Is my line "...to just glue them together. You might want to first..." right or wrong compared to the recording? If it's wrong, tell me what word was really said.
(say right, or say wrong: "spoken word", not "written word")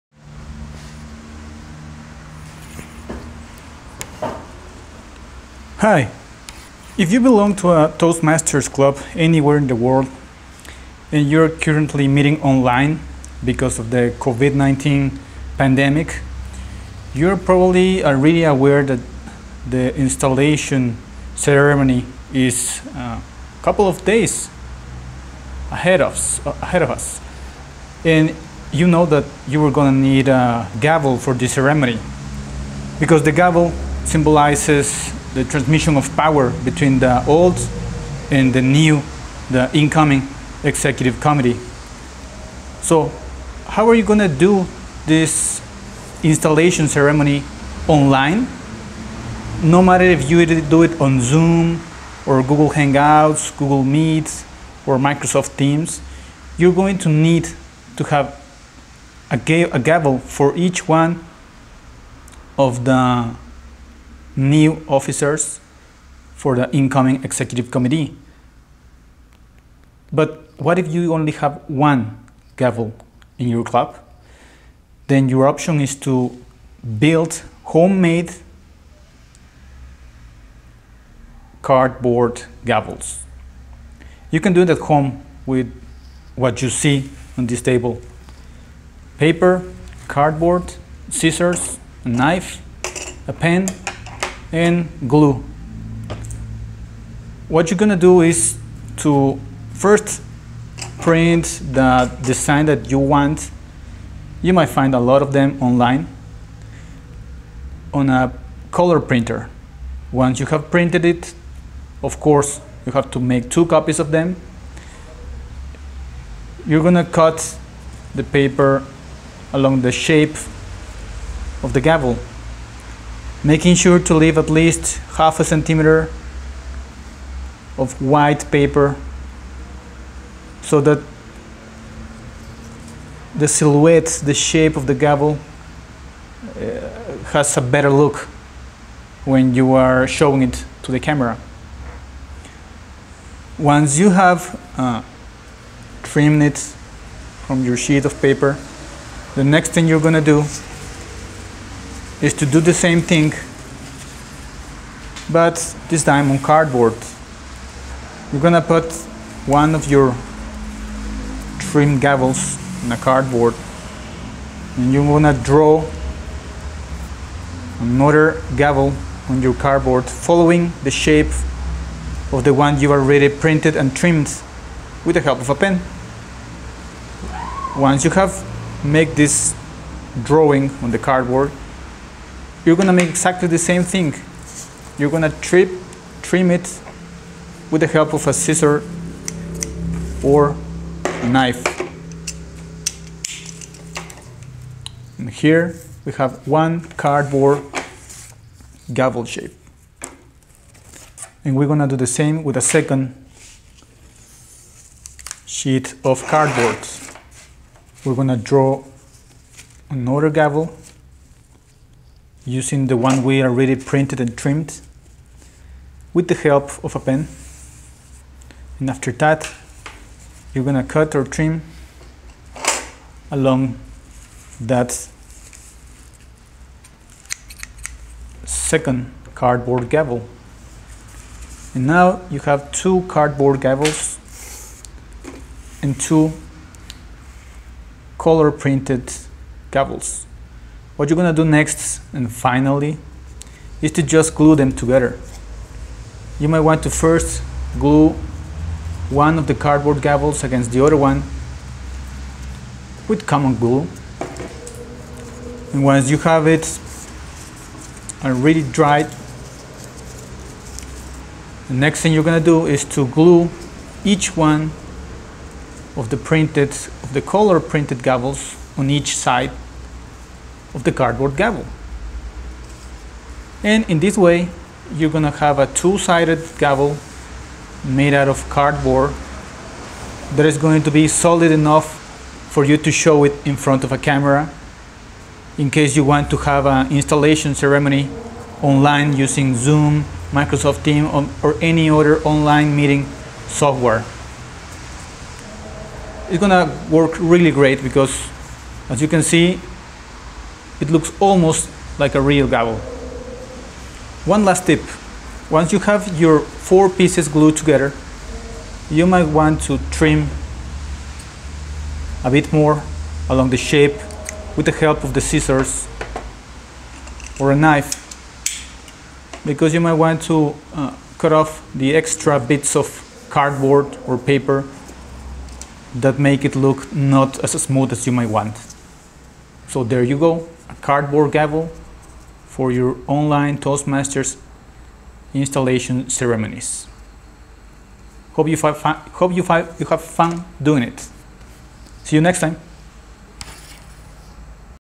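right.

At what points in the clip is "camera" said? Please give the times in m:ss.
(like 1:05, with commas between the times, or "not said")
2:20, 4:43.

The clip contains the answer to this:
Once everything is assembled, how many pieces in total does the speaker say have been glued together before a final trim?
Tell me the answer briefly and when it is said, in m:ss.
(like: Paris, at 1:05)
4, at 5:06.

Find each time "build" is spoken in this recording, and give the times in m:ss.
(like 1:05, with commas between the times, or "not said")
1:16.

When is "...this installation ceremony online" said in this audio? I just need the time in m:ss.
0:45.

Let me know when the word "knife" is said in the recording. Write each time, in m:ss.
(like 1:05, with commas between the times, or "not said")
1:32, 3:11, 5:17.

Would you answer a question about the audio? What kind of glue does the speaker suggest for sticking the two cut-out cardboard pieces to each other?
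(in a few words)
Common glue.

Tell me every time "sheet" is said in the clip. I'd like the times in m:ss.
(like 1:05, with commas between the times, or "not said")
2:27, 3:25.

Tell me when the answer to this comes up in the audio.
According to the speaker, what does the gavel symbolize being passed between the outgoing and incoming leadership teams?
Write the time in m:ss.
0:36.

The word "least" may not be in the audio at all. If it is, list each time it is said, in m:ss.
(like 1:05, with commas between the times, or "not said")
2:04.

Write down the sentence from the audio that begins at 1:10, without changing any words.
But what if you only have one gavel in your club?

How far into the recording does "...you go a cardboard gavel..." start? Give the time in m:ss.
5:30.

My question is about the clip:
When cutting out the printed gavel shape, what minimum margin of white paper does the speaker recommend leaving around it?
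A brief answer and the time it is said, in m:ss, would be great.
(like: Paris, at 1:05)
Half a centimeter, at 2:05.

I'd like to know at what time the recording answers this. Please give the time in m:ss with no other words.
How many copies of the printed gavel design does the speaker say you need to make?
1:53.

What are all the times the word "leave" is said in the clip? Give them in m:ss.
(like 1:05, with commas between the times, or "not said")
2:04.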